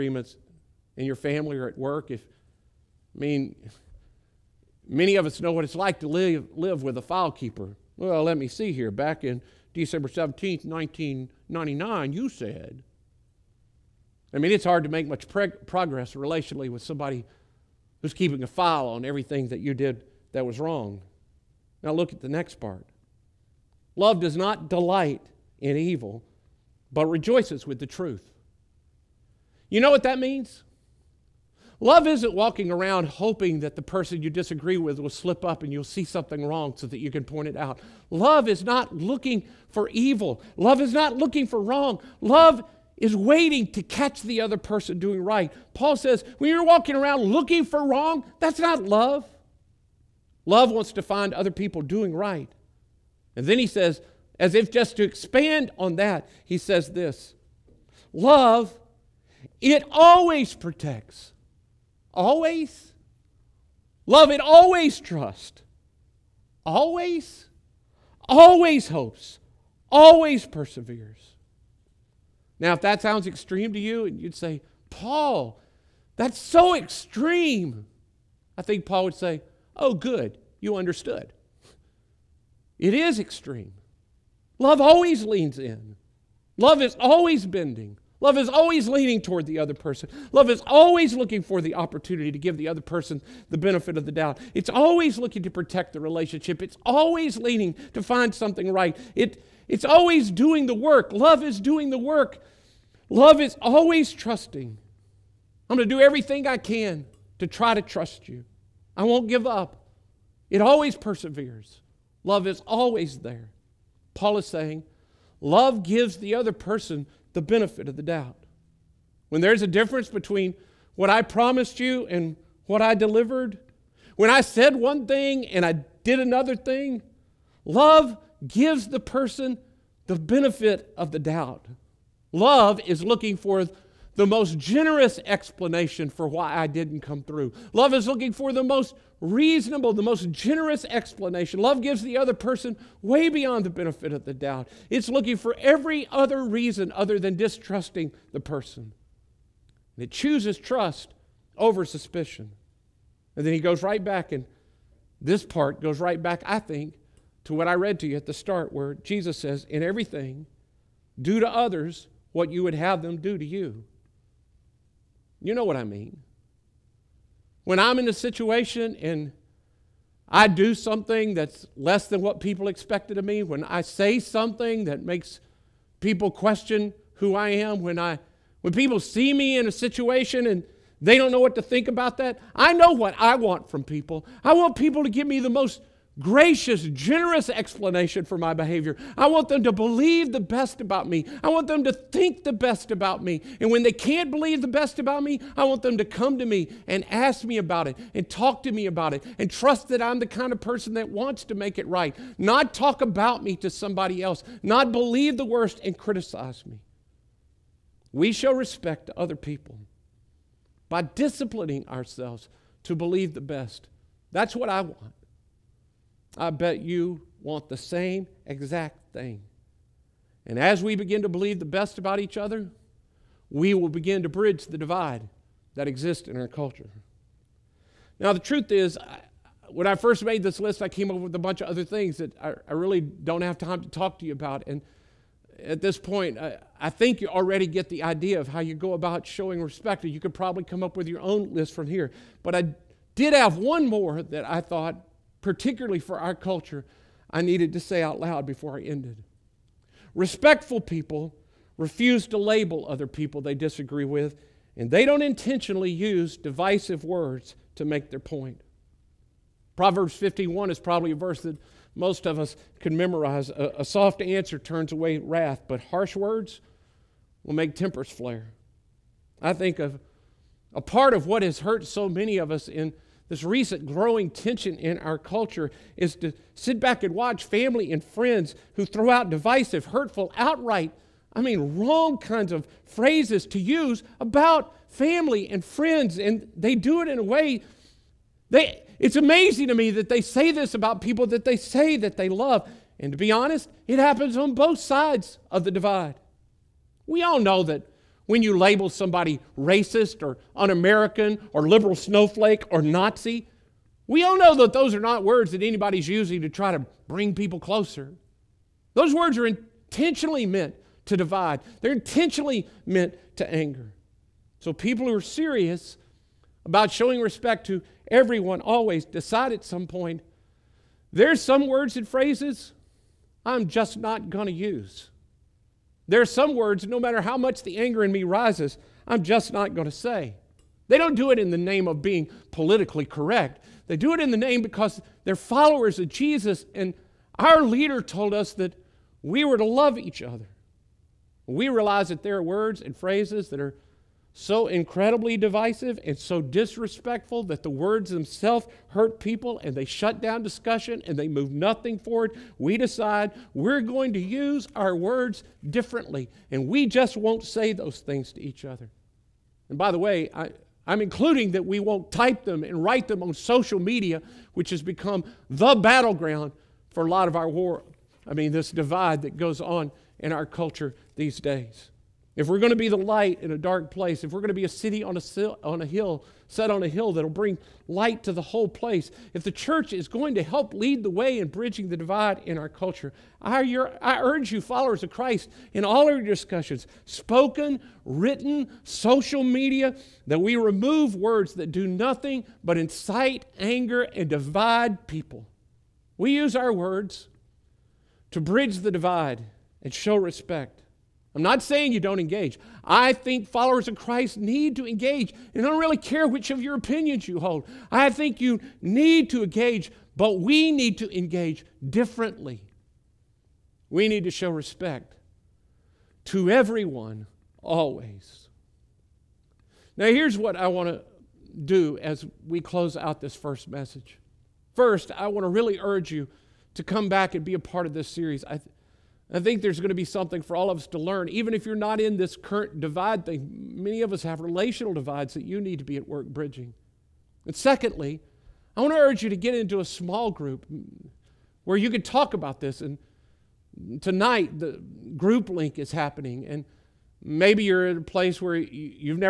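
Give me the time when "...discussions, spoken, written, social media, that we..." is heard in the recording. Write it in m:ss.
6:26.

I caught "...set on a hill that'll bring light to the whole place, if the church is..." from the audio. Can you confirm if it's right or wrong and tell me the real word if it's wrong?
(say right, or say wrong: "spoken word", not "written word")
right.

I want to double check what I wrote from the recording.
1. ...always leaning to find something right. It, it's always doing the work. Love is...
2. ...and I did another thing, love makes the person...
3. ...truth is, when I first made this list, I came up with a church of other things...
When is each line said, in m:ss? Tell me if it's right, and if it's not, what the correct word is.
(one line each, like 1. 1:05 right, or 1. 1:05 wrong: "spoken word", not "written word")
1. 1:36 right
2. 2:05 wrong: "gives", not "makes"
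3. 3:48 wrong: "bunch", not "church".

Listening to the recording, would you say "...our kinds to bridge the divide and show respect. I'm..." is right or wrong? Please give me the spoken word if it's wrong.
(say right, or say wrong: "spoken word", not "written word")
wrong: "words", not "kinds".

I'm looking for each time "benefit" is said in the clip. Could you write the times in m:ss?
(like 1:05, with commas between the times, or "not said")
1:33, 1:57, 2:10, 2:23.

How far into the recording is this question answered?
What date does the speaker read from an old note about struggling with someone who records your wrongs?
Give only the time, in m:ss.
0:09.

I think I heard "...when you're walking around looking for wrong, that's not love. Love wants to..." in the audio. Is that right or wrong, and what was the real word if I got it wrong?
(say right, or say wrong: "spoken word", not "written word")
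right.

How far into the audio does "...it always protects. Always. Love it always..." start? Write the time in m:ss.
0:59.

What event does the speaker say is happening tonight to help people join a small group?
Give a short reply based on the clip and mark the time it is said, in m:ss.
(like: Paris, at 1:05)
The group link, at 7:24.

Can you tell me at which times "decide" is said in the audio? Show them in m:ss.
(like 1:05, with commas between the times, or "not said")
5:19, 5:52.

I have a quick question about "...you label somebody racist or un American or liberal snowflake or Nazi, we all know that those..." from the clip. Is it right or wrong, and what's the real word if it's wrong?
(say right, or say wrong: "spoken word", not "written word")
right.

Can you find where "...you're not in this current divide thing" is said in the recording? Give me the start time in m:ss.
7:11.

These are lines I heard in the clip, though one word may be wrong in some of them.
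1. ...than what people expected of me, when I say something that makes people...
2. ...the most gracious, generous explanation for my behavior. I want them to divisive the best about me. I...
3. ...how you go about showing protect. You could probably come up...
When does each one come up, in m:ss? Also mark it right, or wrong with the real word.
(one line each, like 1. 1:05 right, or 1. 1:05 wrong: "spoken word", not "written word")
1. 2:52 right
2. 3:05 wrong: "believe", not "divisive"
3. 3:58 wrong: "respect", not "protect".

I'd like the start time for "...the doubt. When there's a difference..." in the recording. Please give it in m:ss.
1:57.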